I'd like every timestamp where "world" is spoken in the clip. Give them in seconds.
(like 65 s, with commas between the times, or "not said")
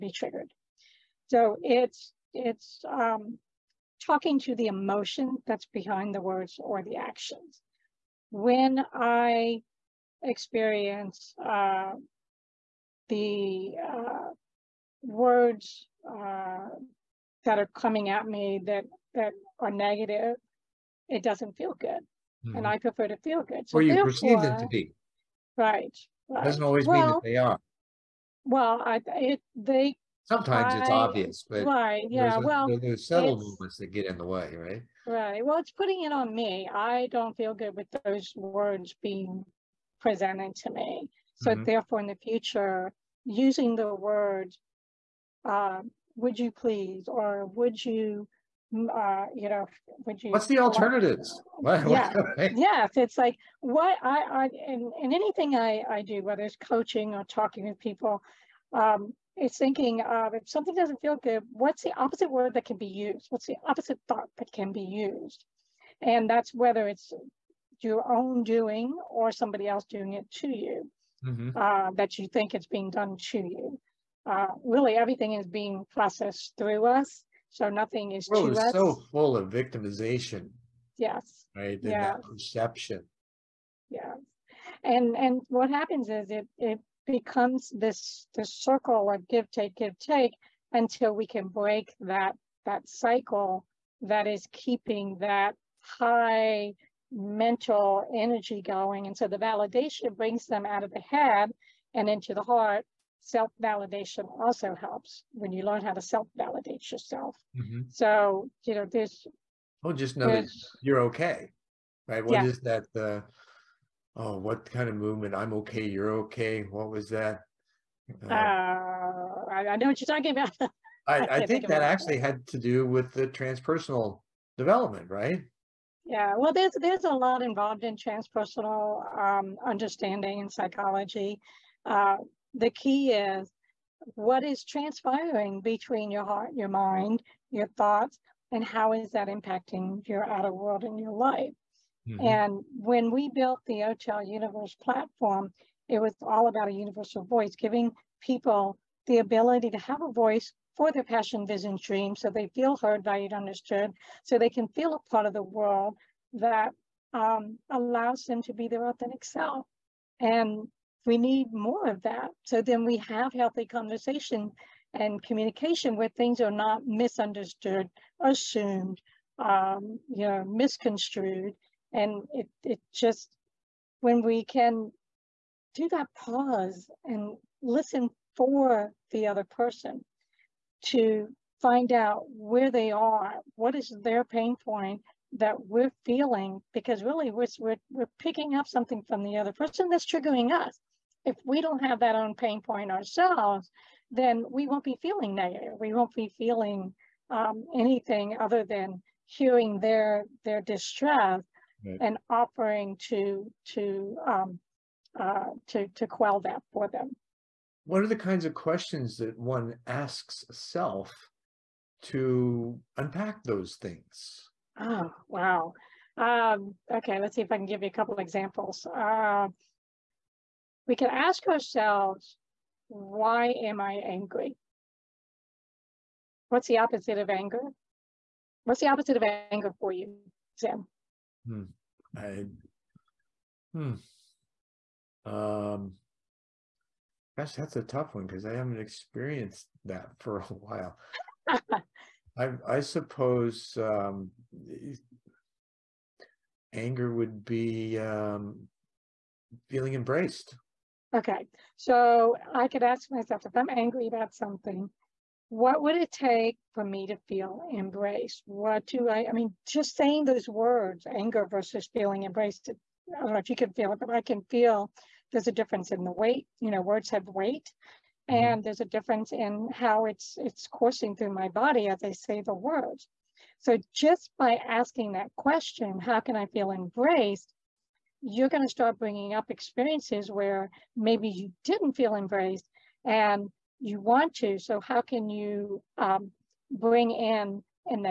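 140 s, 155 s.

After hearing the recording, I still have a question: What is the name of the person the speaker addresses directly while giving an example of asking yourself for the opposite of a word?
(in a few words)
Zen.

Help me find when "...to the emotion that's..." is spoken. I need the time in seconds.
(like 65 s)
4 s.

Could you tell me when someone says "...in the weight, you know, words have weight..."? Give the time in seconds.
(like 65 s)
265 s.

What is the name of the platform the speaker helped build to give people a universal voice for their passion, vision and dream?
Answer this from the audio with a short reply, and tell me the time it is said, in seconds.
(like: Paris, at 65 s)
OTEL Universe, at 143 s.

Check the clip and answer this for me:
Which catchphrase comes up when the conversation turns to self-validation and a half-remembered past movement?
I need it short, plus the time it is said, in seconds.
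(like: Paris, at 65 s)
I'm okay, you're okay, at 115 s.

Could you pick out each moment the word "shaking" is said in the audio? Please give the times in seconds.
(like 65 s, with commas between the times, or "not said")
not said.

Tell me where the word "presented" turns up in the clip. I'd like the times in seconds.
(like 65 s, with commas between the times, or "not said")
40 s.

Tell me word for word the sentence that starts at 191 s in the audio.
If we don't have that own pain point ourselves, then we won't be feeling negative.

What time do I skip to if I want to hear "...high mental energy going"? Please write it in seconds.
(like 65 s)
95 s.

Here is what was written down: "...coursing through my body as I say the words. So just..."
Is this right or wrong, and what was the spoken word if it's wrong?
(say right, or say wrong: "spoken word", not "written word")
right.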